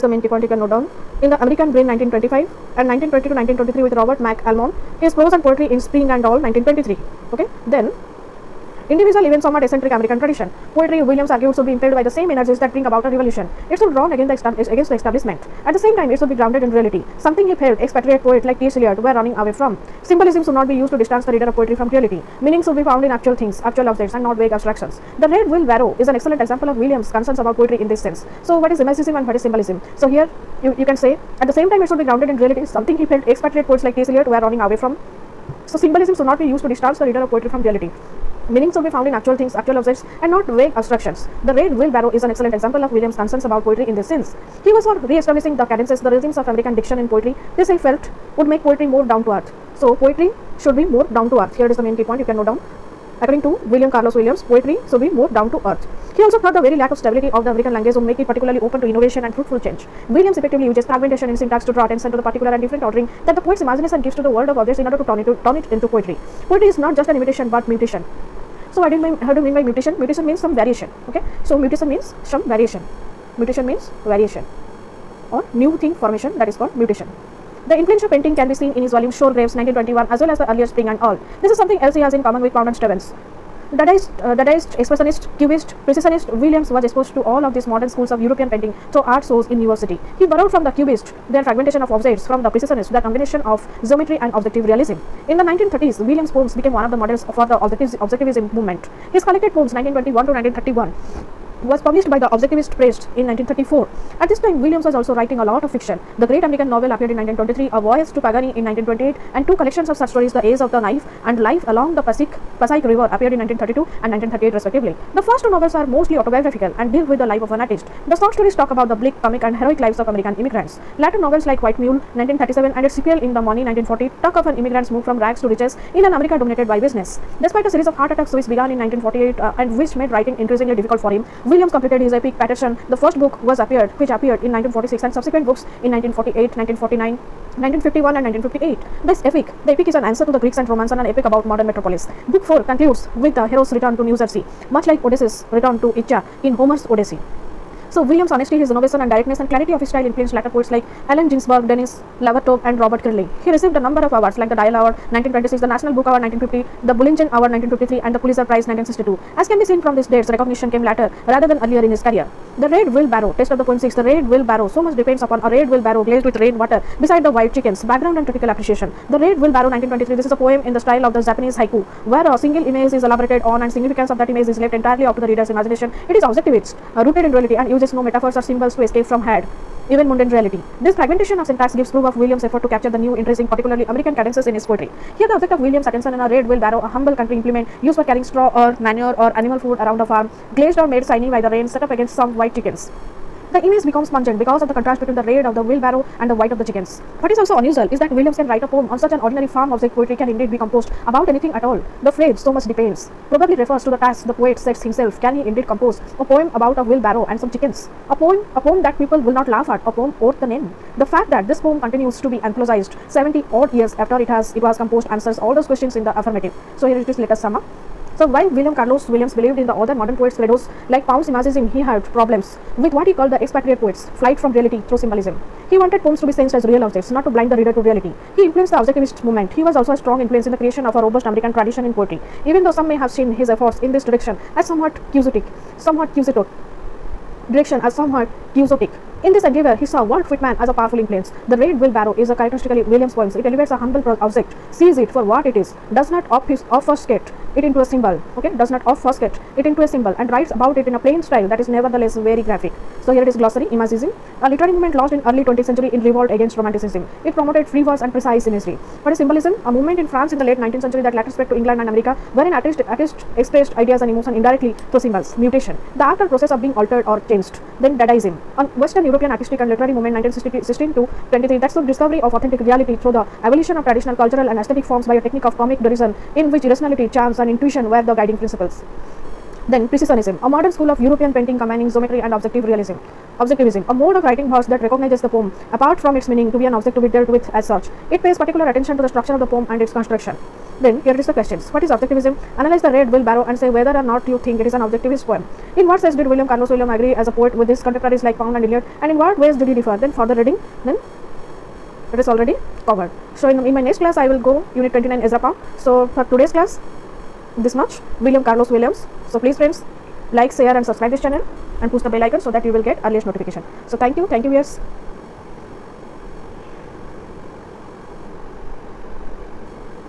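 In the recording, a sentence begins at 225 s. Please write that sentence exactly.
He wanted poems to be sensed as real objects, not to blind the reader to reality.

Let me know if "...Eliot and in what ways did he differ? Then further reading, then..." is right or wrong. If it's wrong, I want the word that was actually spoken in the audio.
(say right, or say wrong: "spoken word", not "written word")
right.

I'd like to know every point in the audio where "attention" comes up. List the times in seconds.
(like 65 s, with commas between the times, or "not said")
61 s, 185 s, 288 s.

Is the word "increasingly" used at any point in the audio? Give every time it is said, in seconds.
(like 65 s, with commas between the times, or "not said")
130 s.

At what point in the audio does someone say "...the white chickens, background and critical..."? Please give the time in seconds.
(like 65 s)
167 s.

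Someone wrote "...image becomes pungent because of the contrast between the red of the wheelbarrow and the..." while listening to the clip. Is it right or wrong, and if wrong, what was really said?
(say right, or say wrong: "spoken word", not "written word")
right.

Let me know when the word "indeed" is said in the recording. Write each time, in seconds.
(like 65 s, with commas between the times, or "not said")
200 s, 205 s.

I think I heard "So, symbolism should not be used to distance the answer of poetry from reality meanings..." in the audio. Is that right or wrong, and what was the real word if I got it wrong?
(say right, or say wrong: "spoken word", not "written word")
wrong: "reader", not "answer".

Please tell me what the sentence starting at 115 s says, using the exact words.
The first two novels are mostly autobiographical and deal with the life of an artist.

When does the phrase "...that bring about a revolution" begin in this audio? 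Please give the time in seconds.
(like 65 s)
12 s.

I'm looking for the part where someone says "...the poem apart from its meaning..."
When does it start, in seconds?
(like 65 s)
285 s.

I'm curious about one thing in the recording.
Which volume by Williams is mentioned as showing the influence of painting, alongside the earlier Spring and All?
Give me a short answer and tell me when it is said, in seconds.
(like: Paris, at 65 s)
Sour Grapes, at 79 s.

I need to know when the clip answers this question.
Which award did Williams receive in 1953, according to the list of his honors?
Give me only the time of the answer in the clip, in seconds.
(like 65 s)
156 s.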